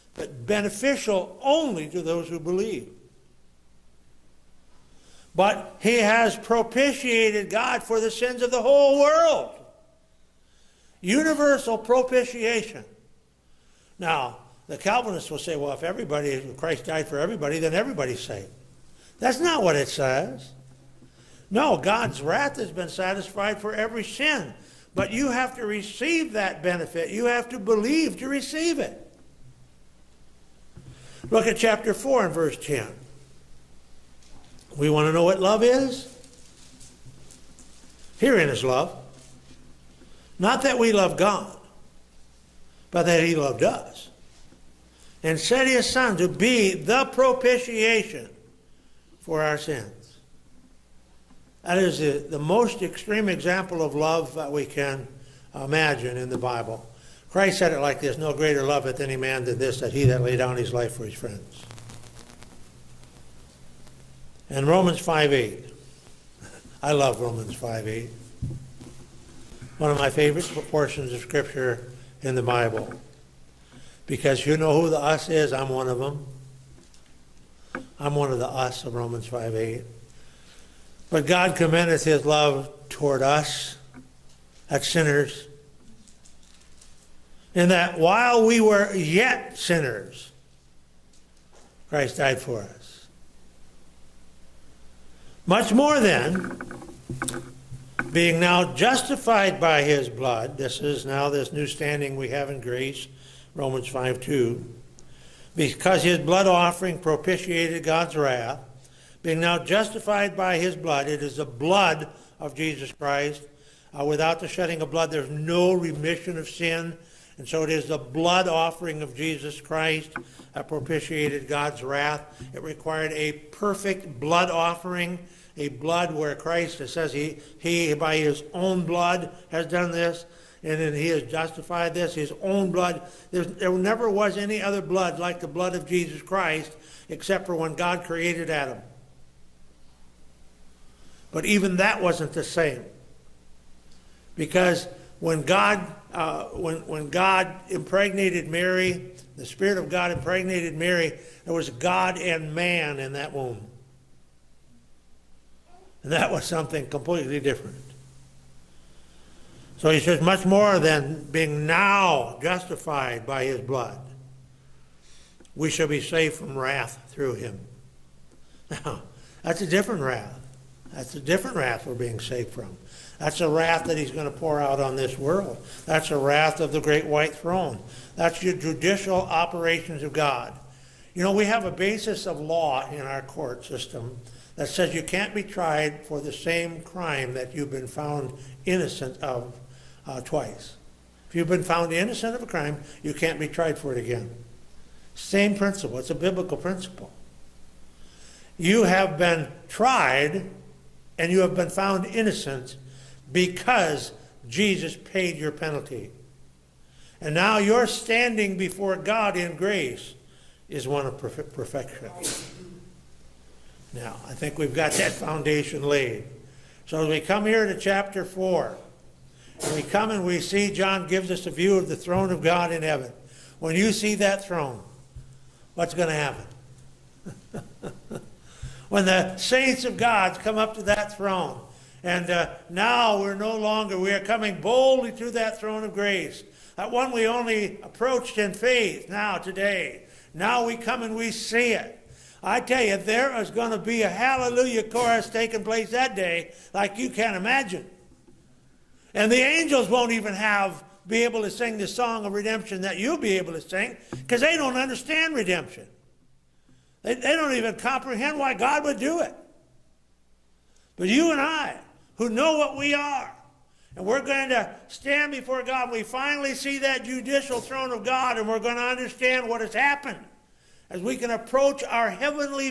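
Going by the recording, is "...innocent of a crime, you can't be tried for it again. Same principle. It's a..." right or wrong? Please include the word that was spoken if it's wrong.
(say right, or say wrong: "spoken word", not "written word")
right.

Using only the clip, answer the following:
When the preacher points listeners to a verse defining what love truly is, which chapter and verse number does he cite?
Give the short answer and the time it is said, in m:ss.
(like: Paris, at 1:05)
Chapter 4, verse 10, at 0:31.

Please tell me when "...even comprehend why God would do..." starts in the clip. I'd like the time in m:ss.
4:17.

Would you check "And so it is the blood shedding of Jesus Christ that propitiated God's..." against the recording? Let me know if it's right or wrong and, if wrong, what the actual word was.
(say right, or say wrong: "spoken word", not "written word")
wrong: "offering", not "shedding".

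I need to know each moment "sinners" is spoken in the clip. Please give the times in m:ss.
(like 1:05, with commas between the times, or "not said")
1:24, 1:29.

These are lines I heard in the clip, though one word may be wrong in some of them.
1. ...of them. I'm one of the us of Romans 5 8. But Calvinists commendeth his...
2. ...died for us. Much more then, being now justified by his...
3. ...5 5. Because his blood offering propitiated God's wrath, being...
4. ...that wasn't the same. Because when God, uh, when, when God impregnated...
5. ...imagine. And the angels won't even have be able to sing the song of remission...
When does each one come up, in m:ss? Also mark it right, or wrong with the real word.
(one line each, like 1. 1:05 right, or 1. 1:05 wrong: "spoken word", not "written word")
1. 1:15 wrong: "God", not "Calvinists"
2. 1:32 right
3. 1:43 wrong: "2", not "5"
4. 2:21 right
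5. 4:07 wrong: "redemption", not "remission".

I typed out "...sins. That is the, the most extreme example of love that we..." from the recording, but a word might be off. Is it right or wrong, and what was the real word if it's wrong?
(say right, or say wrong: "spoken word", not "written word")
right.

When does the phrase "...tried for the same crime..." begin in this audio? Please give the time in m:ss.
3:05.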